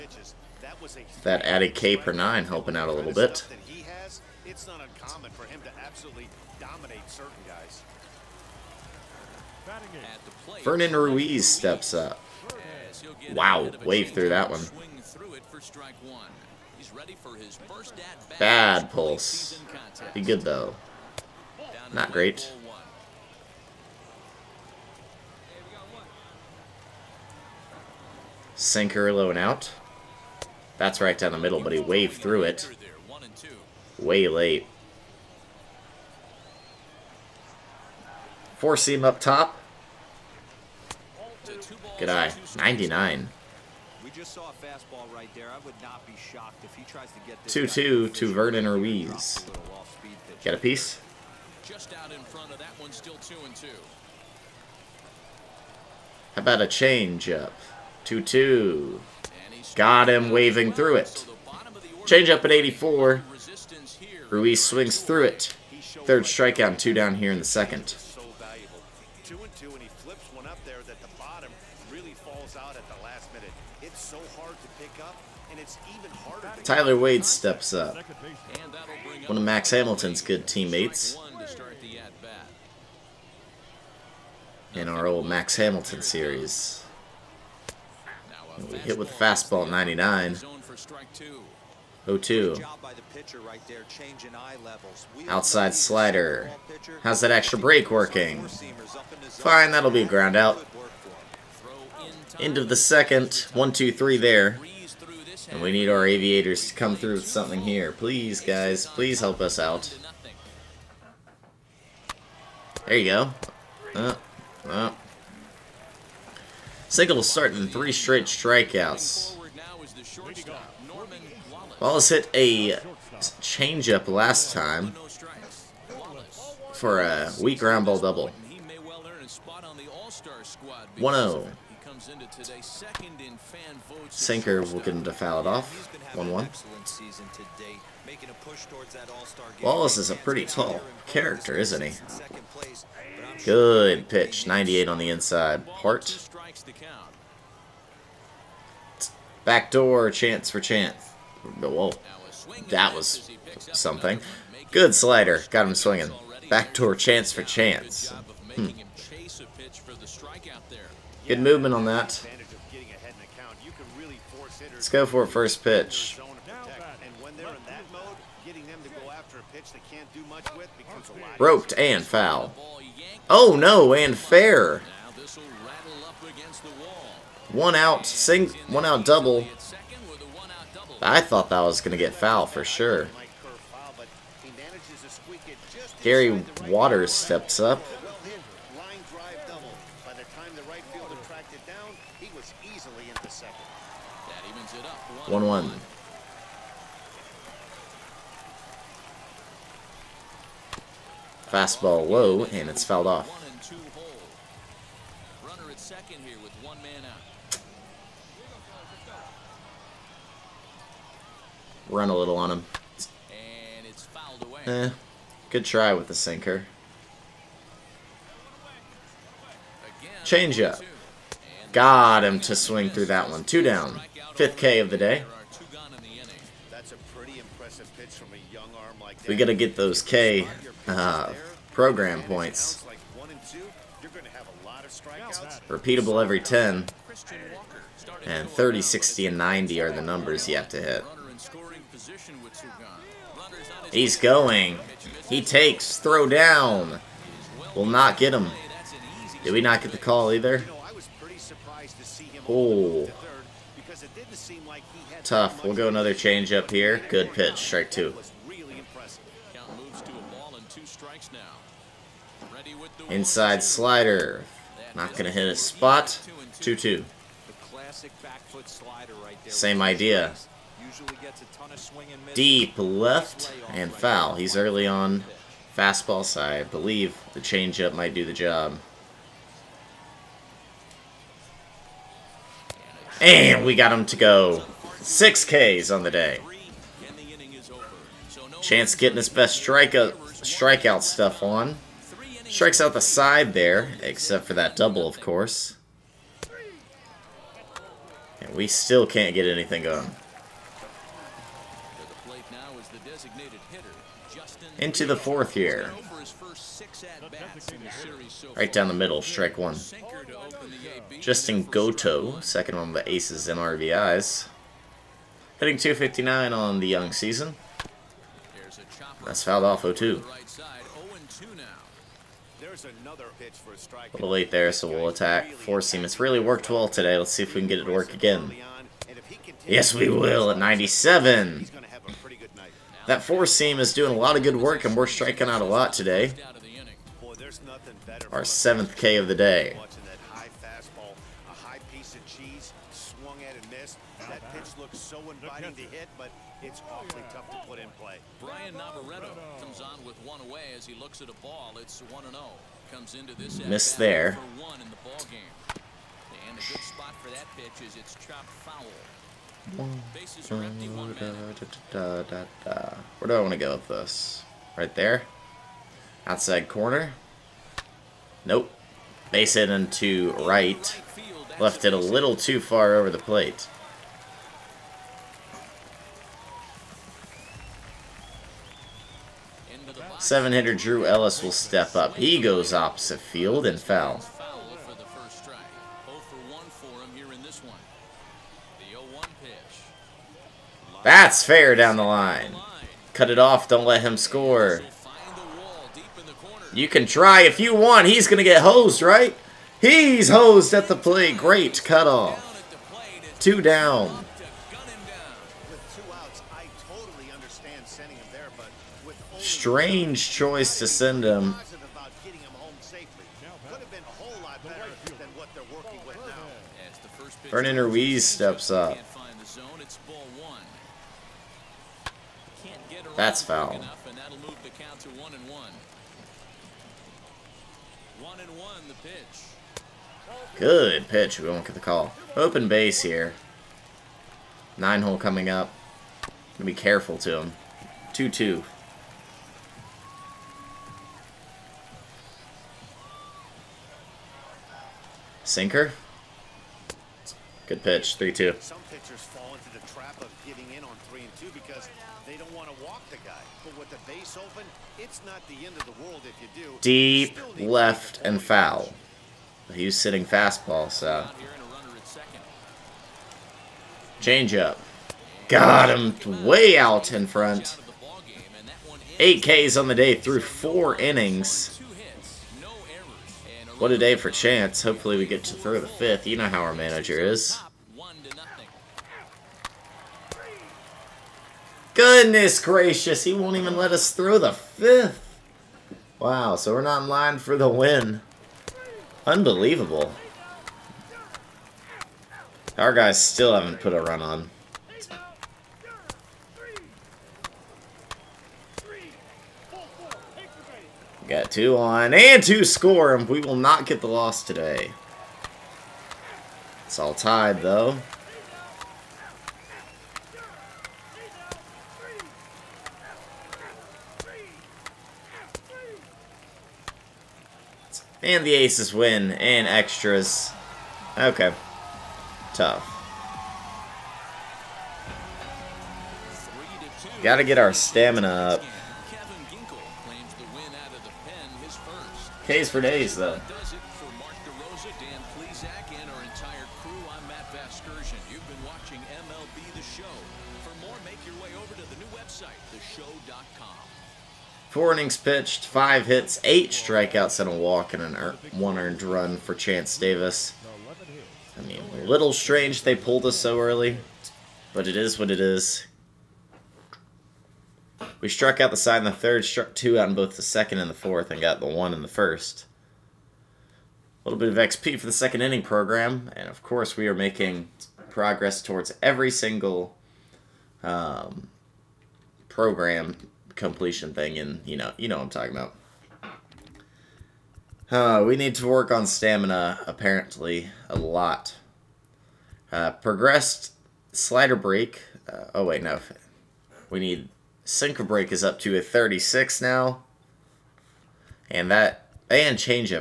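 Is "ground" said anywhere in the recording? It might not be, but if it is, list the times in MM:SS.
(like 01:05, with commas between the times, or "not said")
01:40, 02:07.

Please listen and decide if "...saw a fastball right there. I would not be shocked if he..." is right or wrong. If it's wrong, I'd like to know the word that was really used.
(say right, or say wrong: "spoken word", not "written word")
right.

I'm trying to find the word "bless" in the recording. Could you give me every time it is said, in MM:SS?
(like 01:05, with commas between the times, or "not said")
not said.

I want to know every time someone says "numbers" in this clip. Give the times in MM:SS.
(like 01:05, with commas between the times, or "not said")
04:00.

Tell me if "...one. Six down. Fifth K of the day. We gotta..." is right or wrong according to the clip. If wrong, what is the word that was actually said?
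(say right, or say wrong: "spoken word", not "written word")
wrong: "Two", not "Six".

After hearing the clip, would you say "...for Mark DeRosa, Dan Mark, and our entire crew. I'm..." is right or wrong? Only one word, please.
wrong.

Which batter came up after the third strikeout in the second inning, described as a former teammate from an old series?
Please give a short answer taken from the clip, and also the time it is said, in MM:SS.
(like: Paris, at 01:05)
Tyler Wade, at 01:16.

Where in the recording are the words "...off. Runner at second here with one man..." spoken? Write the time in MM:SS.
03:23.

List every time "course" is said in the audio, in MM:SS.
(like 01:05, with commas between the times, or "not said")
04:55, 09:26.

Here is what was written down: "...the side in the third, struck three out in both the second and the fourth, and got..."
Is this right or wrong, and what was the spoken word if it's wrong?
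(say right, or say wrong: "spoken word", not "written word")
wrong: "two", not "three".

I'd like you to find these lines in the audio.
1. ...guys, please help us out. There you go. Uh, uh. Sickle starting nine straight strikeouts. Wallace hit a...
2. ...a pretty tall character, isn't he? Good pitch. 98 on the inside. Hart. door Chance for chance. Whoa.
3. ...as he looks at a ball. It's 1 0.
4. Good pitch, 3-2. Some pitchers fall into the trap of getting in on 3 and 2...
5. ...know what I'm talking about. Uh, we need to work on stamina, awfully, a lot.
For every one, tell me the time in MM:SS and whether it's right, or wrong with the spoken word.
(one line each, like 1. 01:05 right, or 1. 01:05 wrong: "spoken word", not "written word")
1. 01:48 wrong: "three", not "nine"
2. 02:20 right
3. 05:50 right
4. 07:27 right
5. 09:35 wrong: "apparently", not "awfully".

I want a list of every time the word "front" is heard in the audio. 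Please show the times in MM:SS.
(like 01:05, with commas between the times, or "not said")
00:52, 07:47.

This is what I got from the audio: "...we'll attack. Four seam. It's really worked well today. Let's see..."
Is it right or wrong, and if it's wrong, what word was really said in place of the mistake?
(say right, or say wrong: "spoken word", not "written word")
right.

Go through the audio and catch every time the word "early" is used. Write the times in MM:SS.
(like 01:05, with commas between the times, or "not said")
04:34, 09:13.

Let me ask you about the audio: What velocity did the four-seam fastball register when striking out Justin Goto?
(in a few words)
97.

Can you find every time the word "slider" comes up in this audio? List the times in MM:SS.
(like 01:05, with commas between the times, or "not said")
01:35, 02:34, 04:23, 09:44.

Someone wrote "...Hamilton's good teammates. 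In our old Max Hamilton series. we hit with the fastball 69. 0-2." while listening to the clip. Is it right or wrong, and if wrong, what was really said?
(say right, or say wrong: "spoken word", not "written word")
wrong: "99", not "69".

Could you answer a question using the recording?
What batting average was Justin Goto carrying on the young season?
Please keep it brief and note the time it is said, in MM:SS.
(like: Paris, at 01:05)
259, at 05:15.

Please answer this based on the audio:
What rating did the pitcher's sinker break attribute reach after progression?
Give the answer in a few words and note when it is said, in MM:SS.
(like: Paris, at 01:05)
36, at 09:48.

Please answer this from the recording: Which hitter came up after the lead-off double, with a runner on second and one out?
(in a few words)
Gary Waters.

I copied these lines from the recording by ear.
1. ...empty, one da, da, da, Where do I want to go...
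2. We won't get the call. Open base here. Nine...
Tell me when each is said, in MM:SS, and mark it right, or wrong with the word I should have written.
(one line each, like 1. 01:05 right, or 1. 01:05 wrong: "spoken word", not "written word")
1. 06:00 right
2. 07:11 right.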